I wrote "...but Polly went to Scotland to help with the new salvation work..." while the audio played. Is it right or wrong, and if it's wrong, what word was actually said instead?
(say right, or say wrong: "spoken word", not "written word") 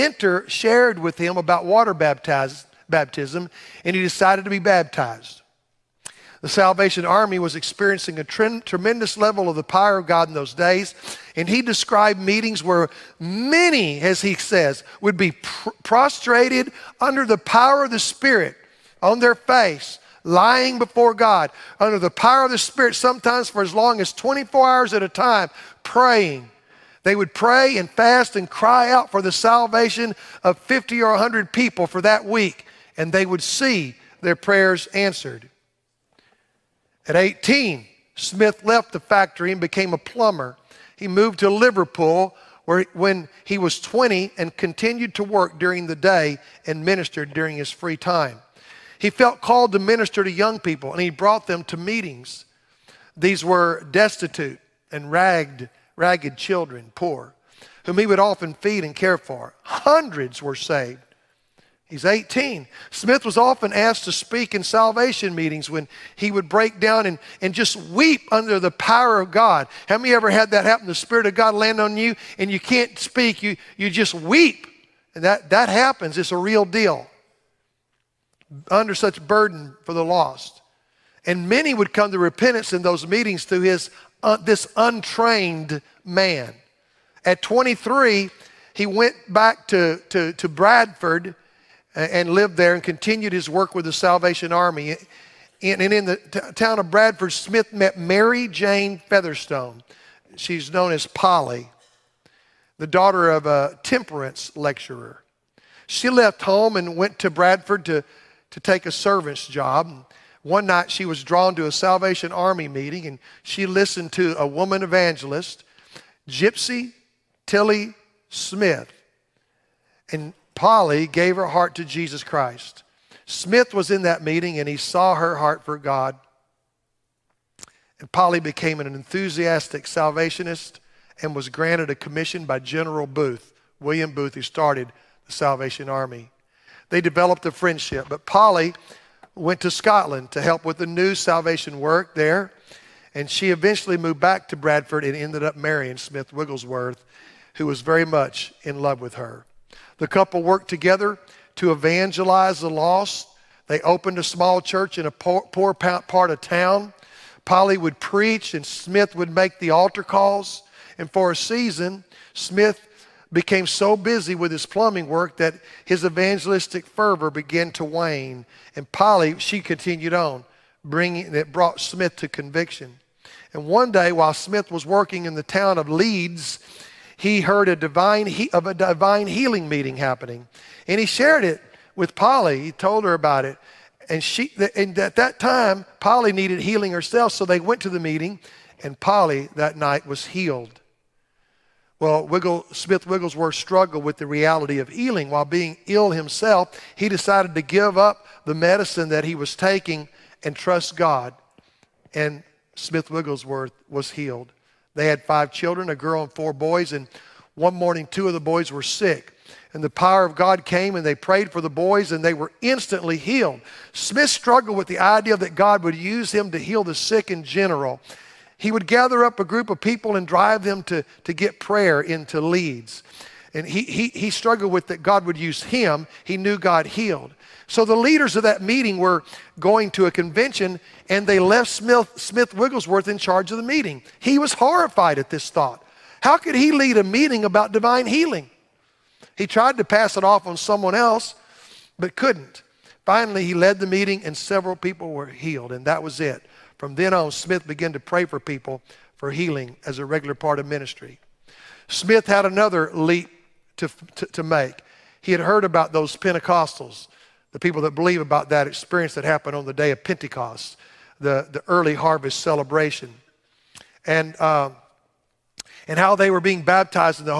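right.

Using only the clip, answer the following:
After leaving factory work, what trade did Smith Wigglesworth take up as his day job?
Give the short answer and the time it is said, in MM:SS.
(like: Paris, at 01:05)
Plumber, at 00:39.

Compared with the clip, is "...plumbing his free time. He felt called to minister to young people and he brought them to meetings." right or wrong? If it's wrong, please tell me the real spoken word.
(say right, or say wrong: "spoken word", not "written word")
wrong: "during", not "plumbing".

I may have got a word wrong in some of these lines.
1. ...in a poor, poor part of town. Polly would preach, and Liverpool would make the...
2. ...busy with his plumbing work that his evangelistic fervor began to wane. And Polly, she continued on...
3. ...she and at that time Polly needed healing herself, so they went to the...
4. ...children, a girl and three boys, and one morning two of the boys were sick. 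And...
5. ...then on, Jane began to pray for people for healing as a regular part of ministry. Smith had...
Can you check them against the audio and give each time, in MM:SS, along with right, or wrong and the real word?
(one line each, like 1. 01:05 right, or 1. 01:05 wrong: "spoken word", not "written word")
1. 02:34 wrong: "Smith", not "Liverpool"
2. 02:43 right
3. 03:04 right
4. 03:25 wrong: "four", not "three"
5. 04:06 wrong: "Smith", not "Jane".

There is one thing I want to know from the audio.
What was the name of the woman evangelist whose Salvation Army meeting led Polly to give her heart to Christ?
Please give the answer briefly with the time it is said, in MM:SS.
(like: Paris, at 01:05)
Gypsy Tilly Smith, at 01:56.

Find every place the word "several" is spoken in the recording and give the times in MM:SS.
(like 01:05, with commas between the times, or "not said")
04:04.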